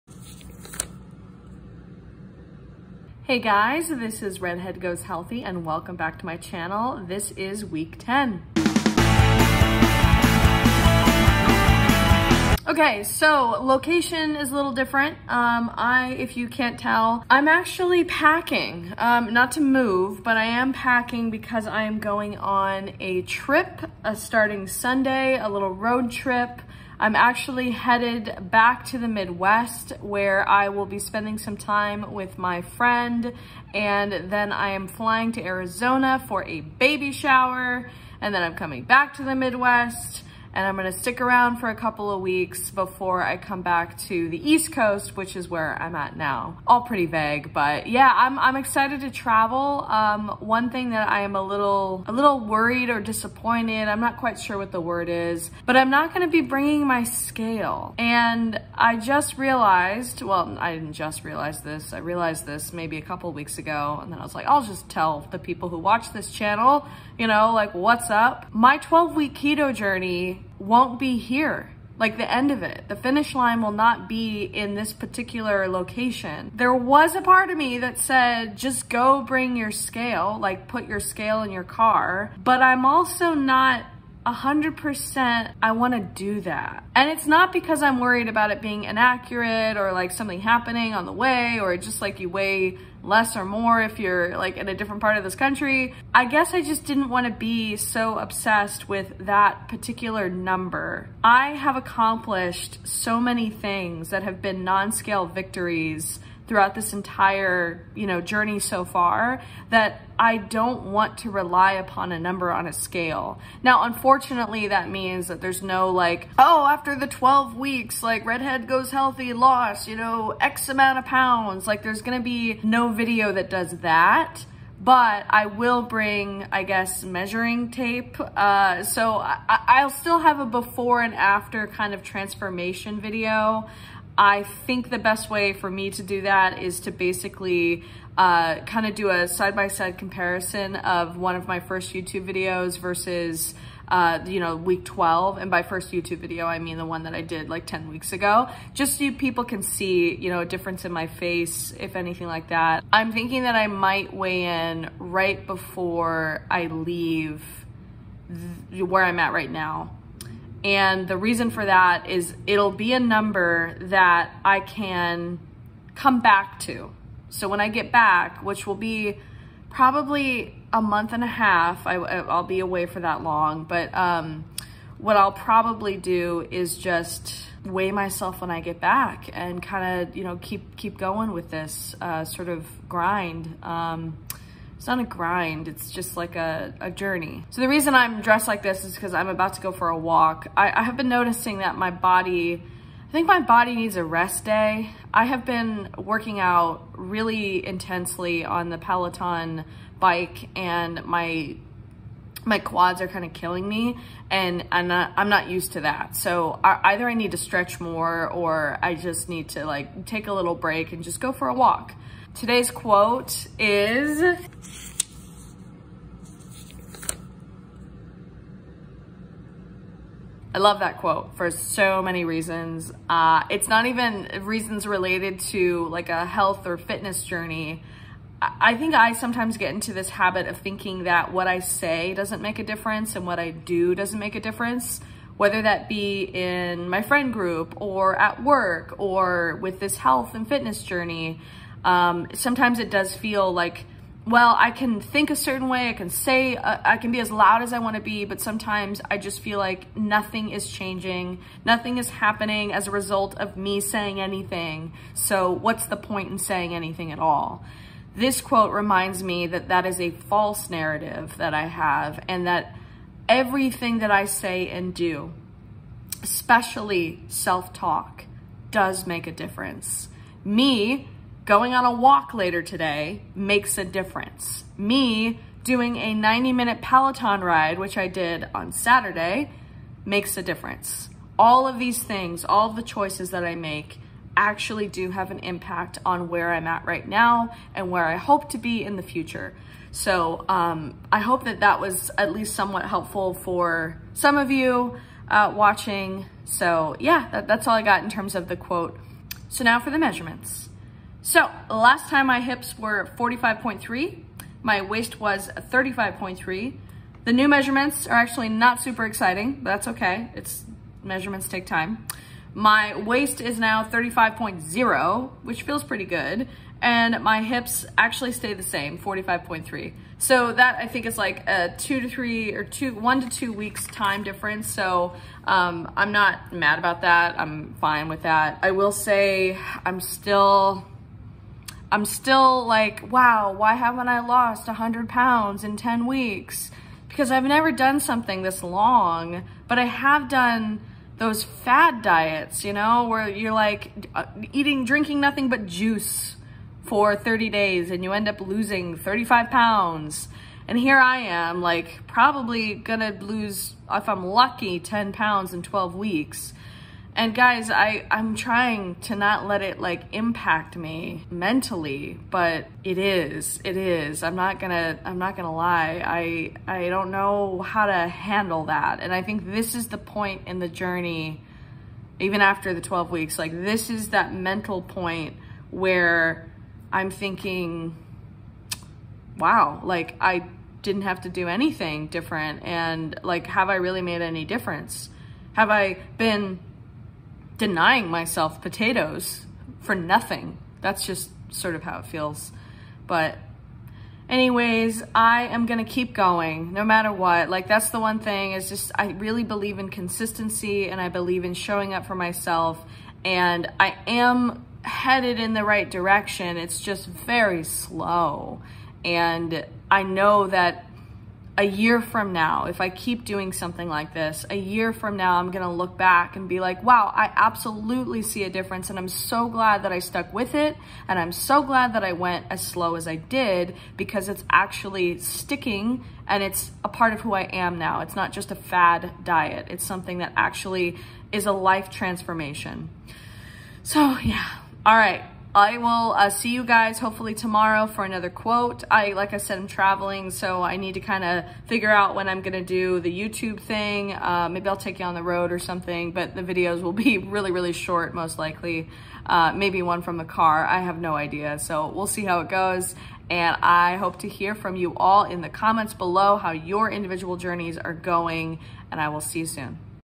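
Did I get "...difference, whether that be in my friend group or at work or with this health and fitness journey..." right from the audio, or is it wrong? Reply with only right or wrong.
right.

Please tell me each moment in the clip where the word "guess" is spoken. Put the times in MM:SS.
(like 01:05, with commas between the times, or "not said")
01:36, 02:06.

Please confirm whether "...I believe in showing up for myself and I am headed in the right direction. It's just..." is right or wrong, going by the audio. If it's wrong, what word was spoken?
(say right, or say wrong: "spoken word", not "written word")
right.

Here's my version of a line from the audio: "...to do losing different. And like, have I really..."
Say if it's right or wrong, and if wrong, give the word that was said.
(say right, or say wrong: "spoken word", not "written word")
wrong: "anything", not "losing".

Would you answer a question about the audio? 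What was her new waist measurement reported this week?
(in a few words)
35.0.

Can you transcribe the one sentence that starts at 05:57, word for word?
And guys, I, I'm trying to not let it like impact me mentally, but it is, it is.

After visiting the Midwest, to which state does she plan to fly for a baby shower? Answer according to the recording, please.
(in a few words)
Arizona.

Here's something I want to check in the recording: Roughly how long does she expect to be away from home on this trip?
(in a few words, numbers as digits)
a month and a half.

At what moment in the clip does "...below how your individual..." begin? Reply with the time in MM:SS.
07:35.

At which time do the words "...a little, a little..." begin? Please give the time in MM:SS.
00:51.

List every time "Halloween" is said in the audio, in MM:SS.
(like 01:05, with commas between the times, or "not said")
not said.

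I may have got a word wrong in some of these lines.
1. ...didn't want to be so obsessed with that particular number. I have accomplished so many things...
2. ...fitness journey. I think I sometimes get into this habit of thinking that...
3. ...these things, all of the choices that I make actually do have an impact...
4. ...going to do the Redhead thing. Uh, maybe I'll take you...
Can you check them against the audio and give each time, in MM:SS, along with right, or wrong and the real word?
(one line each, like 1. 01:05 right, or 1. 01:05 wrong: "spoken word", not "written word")
1. 01:36 right
2. 03:46 right
3. 04:41 right
4. 07:22 wrong: "YouTube", not "Redhead".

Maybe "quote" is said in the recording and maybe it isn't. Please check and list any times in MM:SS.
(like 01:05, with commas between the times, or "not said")
03:32, 03:40, 04:18, 04:58, 07:18.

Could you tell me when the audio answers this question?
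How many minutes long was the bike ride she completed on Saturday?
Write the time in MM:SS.
04:36.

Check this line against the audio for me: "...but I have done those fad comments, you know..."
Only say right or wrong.
wrong.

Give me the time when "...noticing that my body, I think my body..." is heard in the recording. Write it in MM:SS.
03:11.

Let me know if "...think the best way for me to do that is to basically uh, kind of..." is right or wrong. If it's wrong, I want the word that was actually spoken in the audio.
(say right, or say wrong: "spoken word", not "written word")
right.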